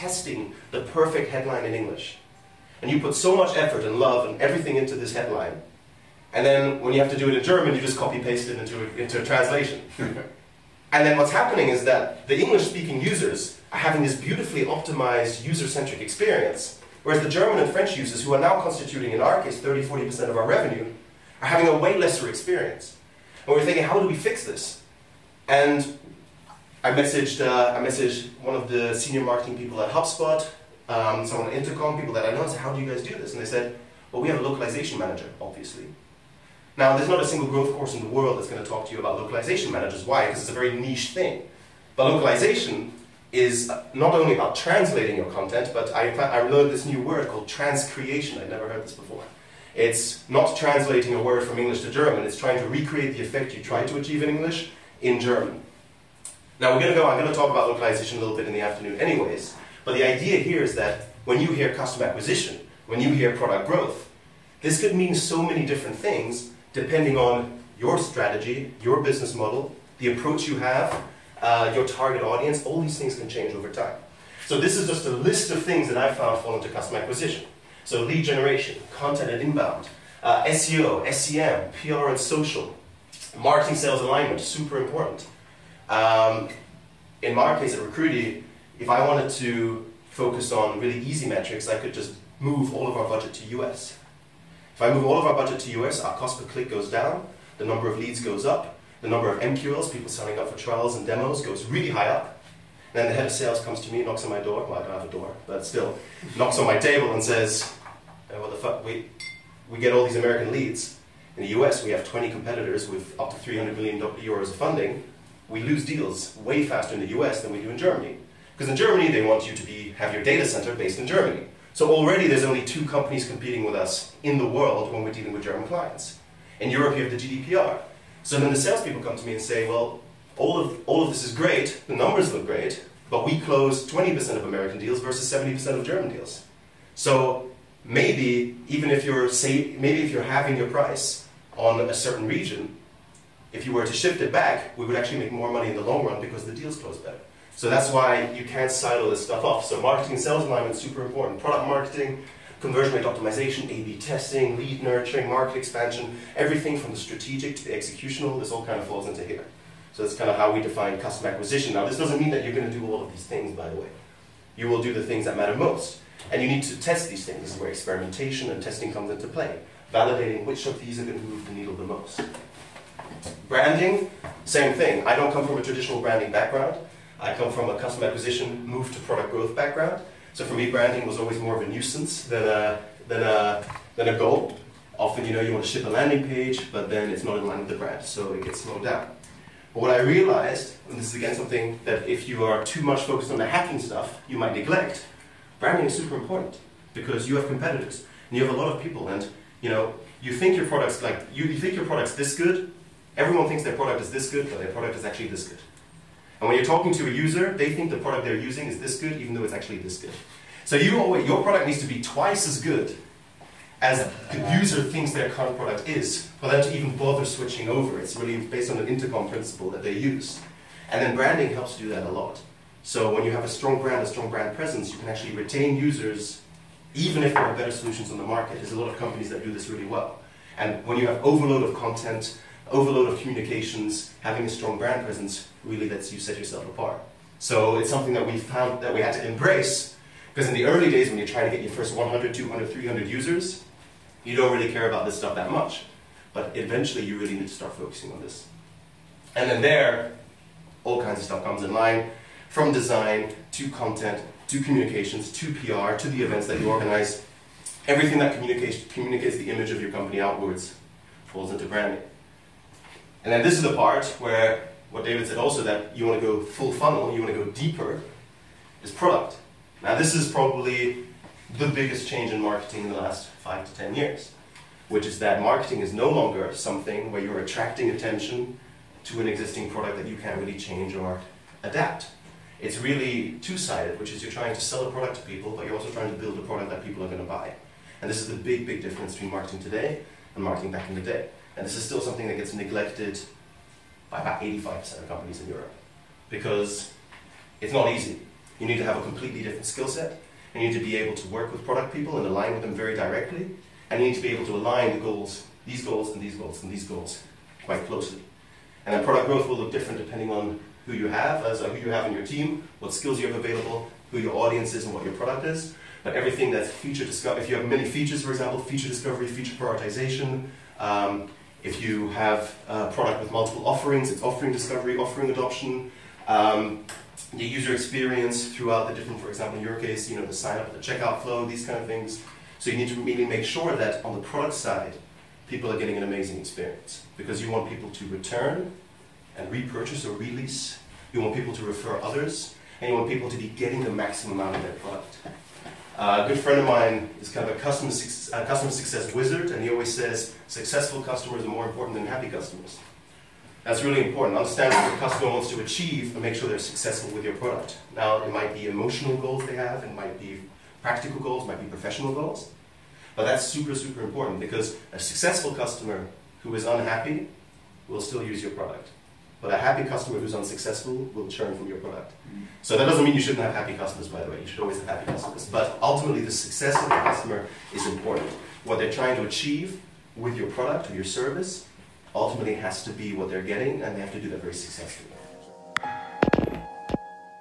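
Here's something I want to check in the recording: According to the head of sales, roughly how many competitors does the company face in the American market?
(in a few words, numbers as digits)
20.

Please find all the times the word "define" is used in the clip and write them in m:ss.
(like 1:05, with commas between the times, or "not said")
2:40.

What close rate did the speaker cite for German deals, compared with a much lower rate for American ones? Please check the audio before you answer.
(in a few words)
70%.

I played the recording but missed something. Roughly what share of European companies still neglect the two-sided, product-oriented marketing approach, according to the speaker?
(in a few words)
85%.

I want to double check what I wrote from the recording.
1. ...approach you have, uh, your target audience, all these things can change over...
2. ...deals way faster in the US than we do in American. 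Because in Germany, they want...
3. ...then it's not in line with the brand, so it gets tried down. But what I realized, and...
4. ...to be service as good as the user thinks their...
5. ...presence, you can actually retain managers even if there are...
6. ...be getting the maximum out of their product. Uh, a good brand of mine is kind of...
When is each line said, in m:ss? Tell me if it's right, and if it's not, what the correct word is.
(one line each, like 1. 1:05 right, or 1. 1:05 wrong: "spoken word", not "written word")
1. 1:10 right
2. 1:55 wrong: "Germany", not "American"
3. 3:06 wrong: "slowed", not "tried"
4. 3:31 wrong: "twice", not "service"
5. 3:44 wrong: "users", not "managers"
6. 5:43 wrong: "friend", not "brand".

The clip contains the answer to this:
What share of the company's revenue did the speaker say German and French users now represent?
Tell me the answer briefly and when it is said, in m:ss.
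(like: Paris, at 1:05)
30-40%, at 0:19.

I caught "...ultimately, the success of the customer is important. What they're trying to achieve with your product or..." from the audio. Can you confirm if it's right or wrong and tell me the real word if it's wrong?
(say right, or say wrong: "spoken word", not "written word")
right.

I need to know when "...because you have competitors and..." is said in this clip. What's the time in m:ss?
3:16.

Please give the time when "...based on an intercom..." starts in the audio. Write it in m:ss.
3:38.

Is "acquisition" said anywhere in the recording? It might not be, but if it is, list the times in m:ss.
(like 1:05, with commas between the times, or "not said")
1:02, 1:16, 2:41, 2:58.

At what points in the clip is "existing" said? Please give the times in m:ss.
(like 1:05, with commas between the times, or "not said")
4:39.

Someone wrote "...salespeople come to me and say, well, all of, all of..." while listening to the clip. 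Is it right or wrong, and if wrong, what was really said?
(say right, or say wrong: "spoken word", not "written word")
right.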